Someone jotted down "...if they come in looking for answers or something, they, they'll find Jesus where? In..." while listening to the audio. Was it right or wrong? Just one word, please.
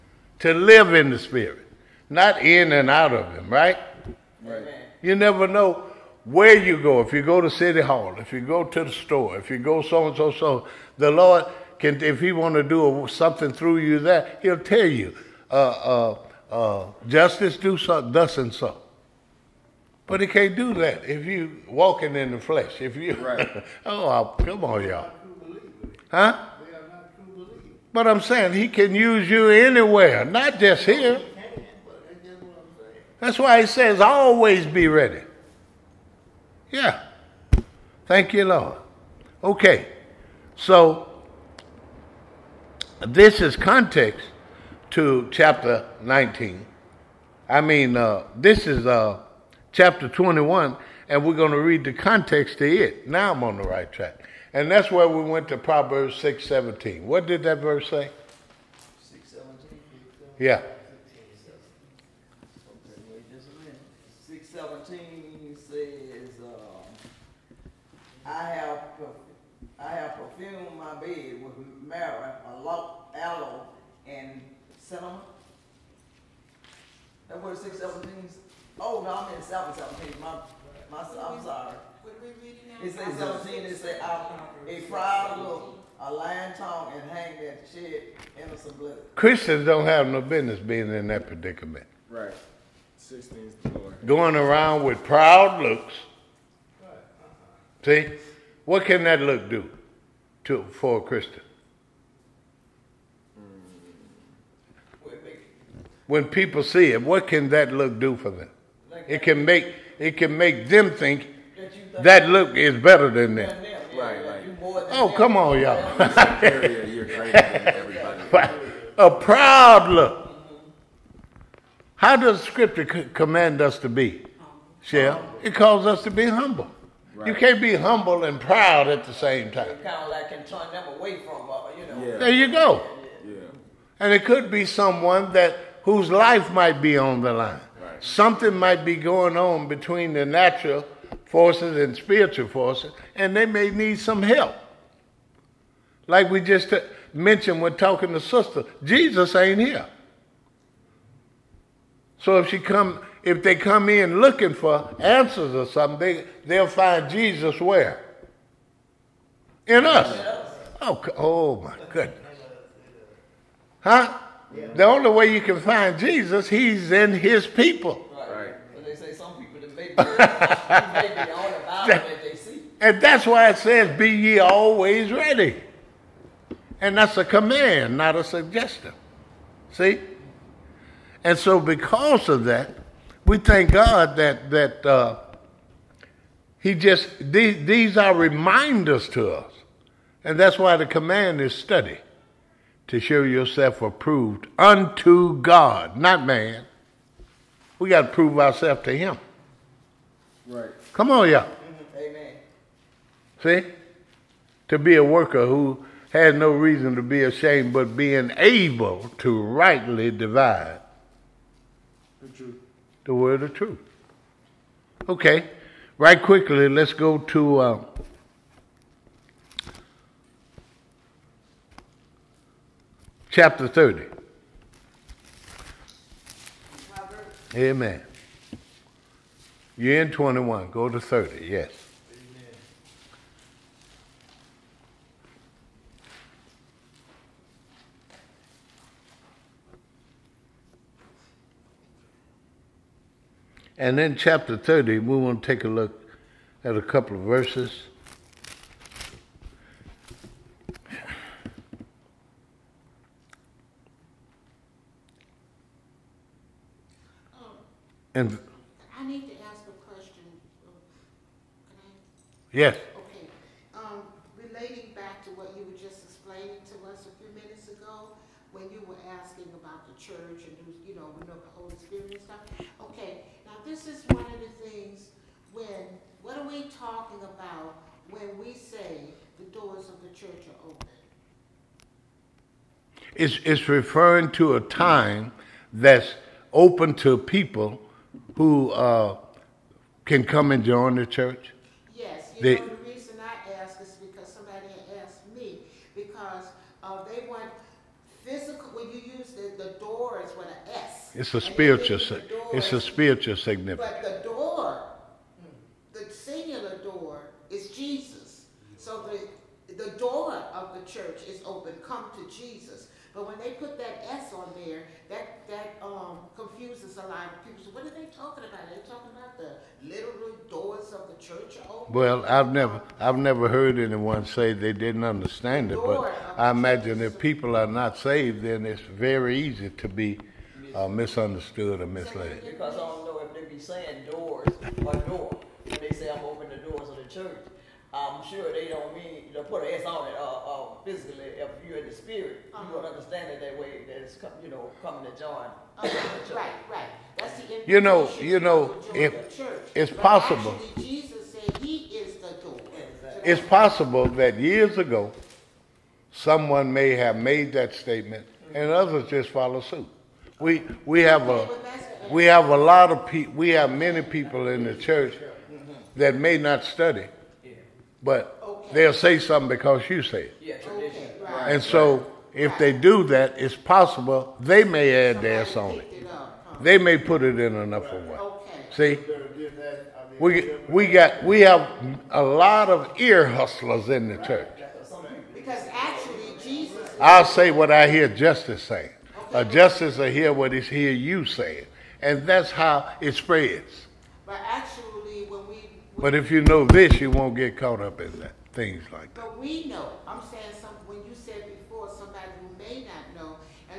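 right.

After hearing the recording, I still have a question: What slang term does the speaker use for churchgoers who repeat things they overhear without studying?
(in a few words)
ear hustlers.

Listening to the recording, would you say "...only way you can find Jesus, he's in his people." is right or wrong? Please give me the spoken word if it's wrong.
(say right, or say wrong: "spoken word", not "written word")
right.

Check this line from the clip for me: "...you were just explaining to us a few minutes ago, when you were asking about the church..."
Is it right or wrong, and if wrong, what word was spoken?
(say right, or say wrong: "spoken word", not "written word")
right.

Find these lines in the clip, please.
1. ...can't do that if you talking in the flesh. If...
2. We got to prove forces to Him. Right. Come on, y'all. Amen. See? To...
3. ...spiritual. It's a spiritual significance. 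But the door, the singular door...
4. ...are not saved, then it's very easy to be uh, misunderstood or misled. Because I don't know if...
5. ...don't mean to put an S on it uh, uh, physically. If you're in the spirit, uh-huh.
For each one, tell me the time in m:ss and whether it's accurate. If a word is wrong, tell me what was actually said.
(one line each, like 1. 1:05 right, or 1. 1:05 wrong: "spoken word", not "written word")
1. 0:20 wrong: "walking", not "talking"
2. 3:17 wrong: "ourselves", not "forces"
3. 5:01 right
4. 5:27 right
5. 5:38 right.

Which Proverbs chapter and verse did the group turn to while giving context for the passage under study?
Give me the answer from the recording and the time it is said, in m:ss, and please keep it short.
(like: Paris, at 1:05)
Proverbs 6:17, at 0:55.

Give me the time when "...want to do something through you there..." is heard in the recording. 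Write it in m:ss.
0:12.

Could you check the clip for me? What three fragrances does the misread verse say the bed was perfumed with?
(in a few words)
myrrh, aloe, and cinnamon.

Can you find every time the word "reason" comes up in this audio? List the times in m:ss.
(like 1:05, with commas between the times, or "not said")
3:26, 4:52.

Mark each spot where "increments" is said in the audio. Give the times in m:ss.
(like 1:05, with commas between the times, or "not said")
not said.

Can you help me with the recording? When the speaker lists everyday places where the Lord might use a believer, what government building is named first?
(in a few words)
City Hall.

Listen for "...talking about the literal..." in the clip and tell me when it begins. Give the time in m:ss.
5:18.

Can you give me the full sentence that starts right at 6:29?
A justice will hear what is hear you saying.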